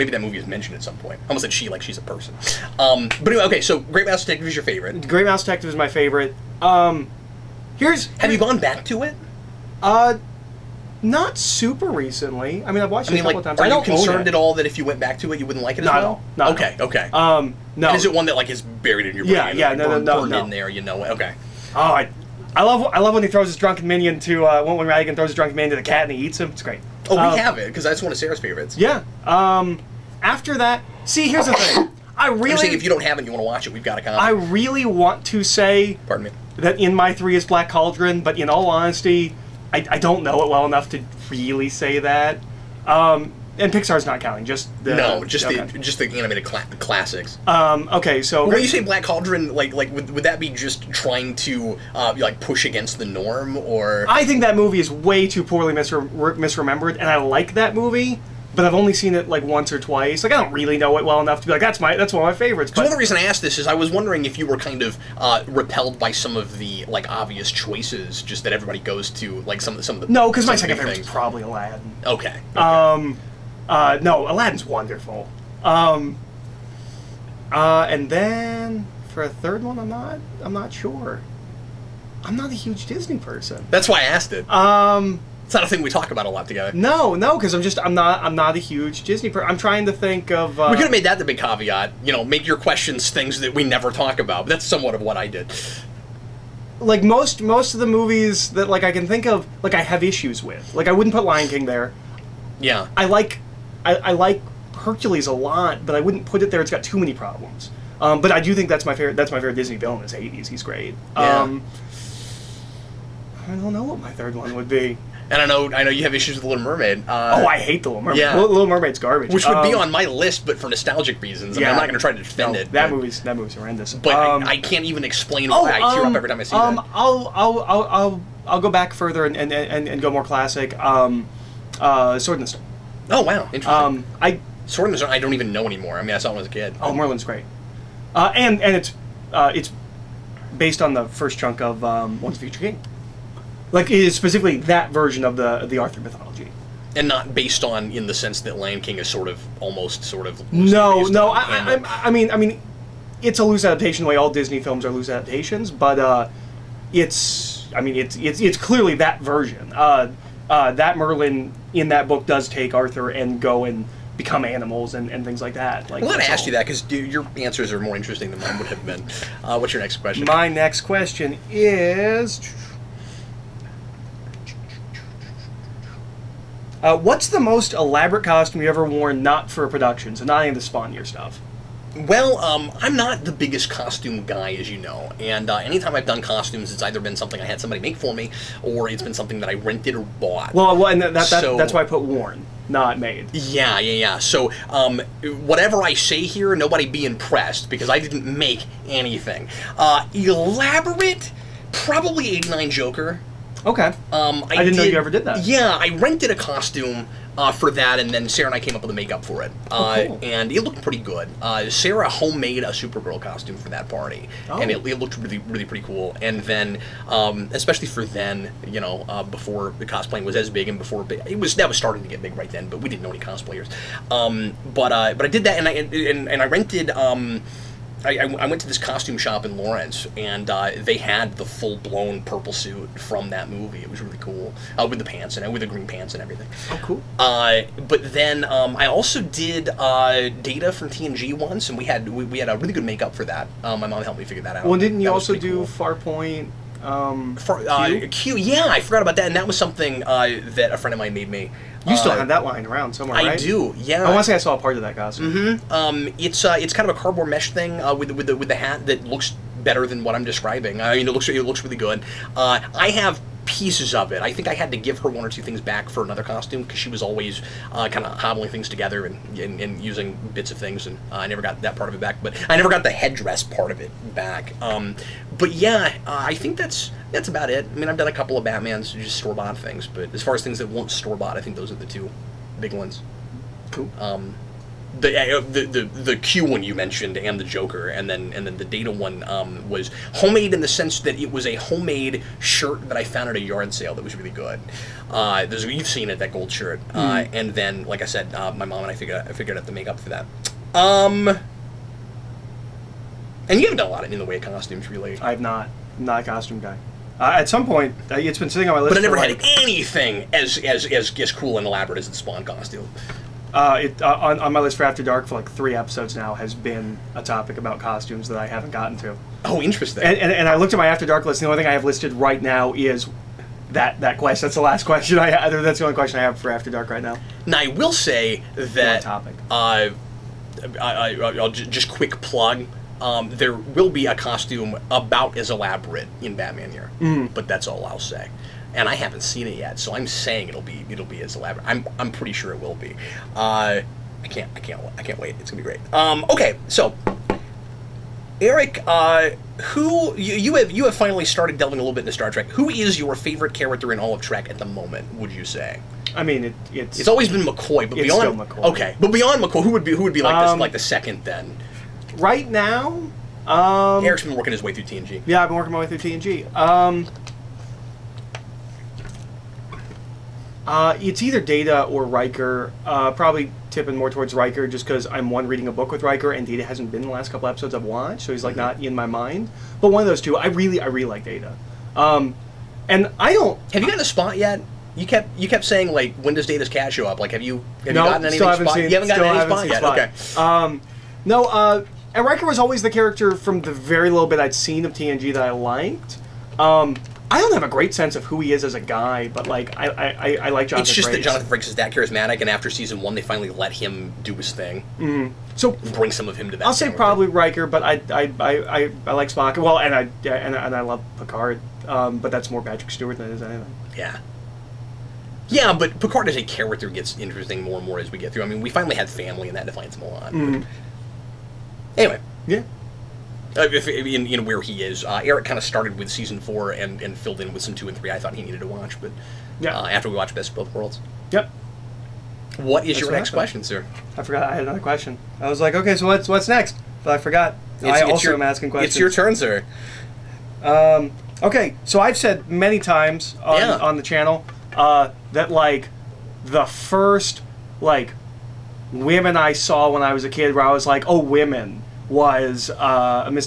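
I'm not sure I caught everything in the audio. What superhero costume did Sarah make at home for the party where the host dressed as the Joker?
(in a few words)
Supergirl.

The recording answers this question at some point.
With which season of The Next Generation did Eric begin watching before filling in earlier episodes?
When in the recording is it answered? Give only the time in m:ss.
7:06.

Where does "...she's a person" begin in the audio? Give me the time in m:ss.
0:01.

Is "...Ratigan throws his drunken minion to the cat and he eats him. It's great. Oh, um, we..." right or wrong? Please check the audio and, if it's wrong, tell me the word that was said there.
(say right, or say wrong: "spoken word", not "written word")
right.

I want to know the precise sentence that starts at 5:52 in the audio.
Who is your favorite character in all of Trek at the moment?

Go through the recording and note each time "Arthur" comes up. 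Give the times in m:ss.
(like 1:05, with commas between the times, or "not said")
2:25, 2:42.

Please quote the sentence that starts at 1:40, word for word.
Like I wouldn't put Lion King there.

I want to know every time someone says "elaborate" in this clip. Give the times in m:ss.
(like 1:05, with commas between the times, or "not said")
2:57, 3:20, 5:11, 5:35, 5:41.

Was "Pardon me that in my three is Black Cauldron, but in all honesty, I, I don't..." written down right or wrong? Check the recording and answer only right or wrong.
right.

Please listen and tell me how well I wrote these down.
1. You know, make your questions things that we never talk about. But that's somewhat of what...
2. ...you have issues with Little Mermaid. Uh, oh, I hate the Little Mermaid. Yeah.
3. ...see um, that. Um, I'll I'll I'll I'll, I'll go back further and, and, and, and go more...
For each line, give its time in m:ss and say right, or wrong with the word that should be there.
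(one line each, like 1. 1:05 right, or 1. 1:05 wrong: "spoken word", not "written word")
1. 1:32 right
2. 1:55 right
3. 2:06 right.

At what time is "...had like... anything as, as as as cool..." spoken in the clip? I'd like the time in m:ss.
5:09.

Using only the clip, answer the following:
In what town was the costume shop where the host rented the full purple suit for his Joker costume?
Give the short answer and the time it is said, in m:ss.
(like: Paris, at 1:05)
Lawrence, at 3:49.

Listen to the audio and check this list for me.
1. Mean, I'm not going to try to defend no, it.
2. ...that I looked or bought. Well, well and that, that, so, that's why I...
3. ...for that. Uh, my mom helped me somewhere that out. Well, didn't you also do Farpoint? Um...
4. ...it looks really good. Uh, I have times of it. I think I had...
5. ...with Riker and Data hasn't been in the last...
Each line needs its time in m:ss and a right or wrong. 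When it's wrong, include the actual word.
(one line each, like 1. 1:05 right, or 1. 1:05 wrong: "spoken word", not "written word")
1. 2:01 right
2. 3:09 wrong: "rented", not "looked"
3. 4:03 wrong: "figure", not "somewhere"
4. 4:21 wrong: "pieces", not "times"
5. 6:15 right.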